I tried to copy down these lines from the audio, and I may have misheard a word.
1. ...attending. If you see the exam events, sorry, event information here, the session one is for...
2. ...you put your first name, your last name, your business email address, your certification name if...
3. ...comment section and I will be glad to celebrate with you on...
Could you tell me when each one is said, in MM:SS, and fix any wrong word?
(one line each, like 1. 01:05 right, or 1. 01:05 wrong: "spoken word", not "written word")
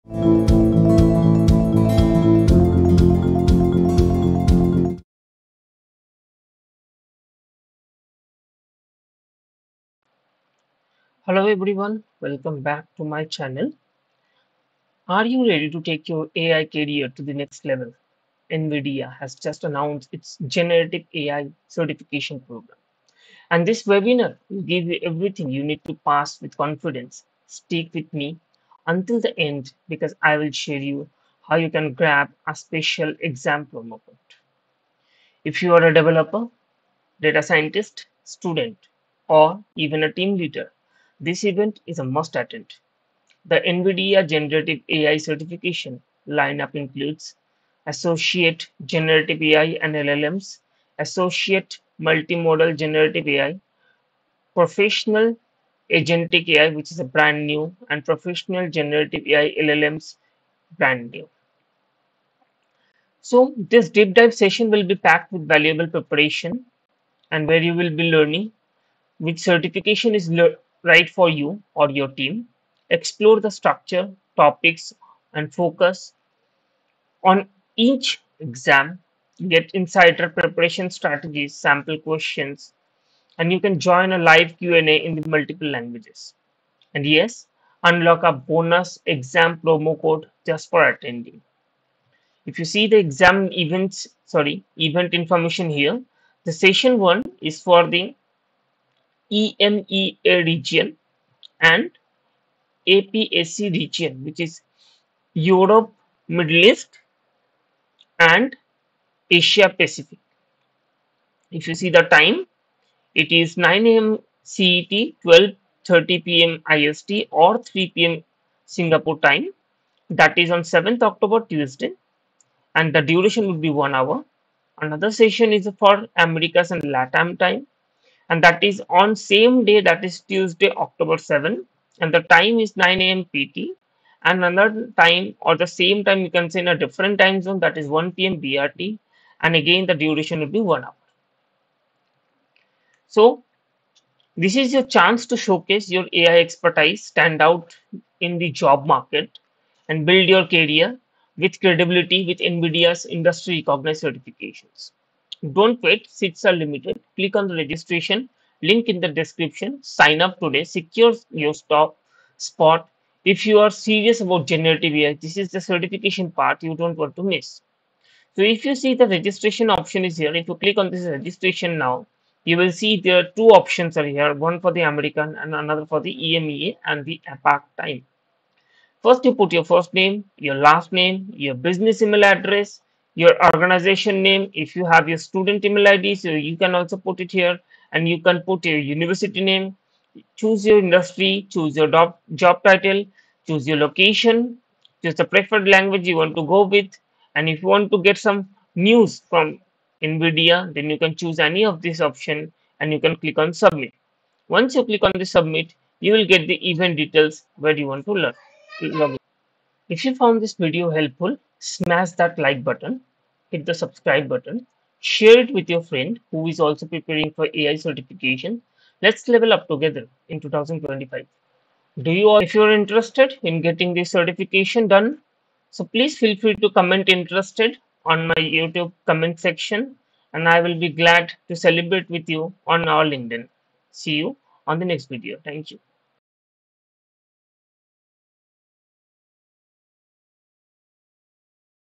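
1. 01:30 right
2. 02:59 wrong: "organization", not "certification"
3. 03:49 right.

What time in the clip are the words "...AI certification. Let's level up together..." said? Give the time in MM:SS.
03:37.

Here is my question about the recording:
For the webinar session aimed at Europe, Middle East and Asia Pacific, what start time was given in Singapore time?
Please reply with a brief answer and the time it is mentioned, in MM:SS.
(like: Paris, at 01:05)
3 p.m., at 01:57.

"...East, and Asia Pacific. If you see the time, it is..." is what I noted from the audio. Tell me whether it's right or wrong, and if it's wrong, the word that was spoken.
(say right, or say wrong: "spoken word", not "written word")
right.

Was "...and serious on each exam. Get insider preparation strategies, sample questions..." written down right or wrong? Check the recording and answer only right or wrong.
wrong.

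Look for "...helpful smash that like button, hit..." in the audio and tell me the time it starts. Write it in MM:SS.
03:30.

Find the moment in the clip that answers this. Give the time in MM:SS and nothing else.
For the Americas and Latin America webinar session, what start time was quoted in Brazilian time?
02:17.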